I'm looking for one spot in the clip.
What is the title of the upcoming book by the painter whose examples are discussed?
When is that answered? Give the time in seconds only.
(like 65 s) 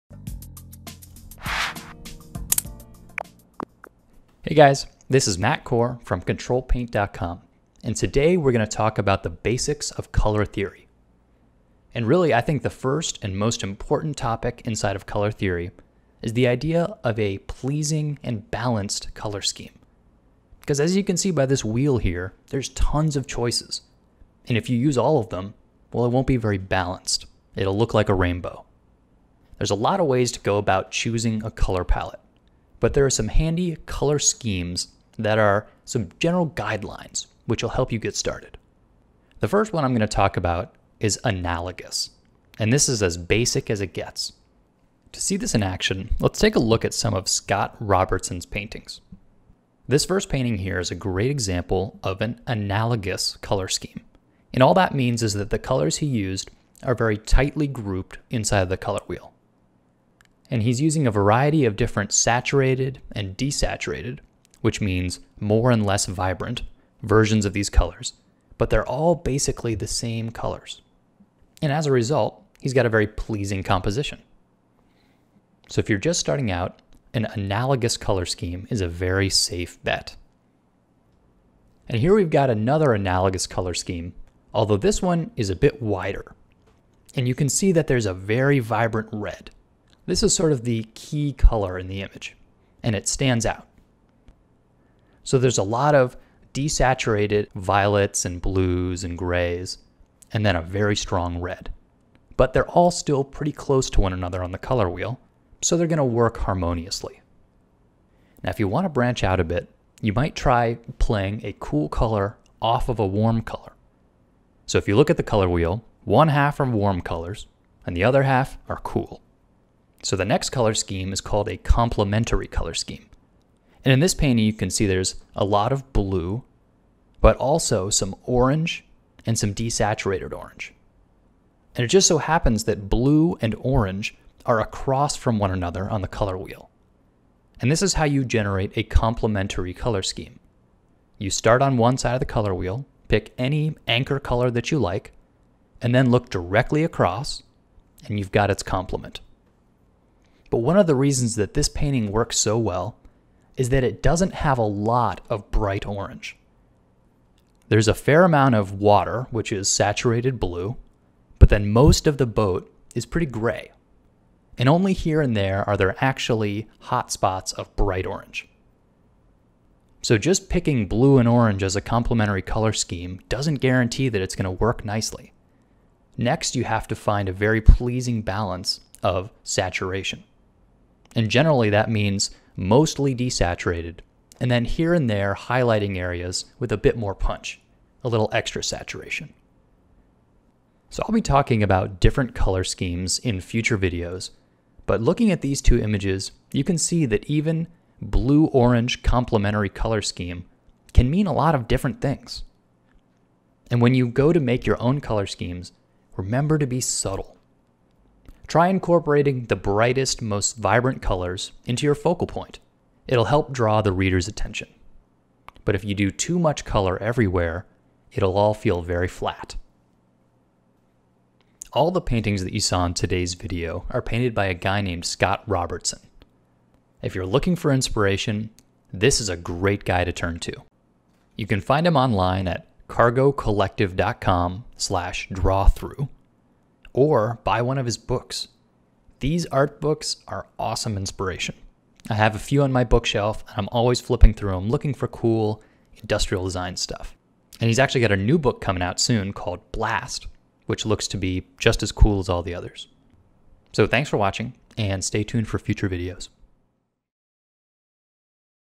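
249 s.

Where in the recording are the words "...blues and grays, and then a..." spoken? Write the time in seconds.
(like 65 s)
98 s.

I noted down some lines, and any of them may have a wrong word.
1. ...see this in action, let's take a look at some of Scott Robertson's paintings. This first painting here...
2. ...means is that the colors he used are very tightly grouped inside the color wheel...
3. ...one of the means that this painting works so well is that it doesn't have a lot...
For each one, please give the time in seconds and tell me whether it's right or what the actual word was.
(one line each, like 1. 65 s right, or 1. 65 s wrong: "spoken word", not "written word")
1. 45 s right
2. 54 s right
3. 150 s wrong: "reasons", not "means".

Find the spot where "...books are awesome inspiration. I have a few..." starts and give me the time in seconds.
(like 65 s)
239 s.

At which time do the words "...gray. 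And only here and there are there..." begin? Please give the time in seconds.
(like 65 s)
163 s.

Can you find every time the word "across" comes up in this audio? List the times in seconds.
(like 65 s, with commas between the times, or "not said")
134 s, 146 s.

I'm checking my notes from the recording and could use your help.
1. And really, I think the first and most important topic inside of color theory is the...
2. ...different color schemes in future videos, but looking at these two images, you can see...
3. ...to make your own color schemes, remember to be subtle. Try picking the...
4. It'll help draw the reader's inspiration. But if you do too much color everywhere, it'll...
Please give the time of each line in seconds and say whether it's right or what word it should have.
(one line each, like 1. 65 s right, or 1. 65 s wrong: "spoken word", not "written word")
1. 11 s right
2. 191 s right
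3. 204 s wrong: "incorporating", not "picking"
4. 213 s wrong: "attention", not "inspiration".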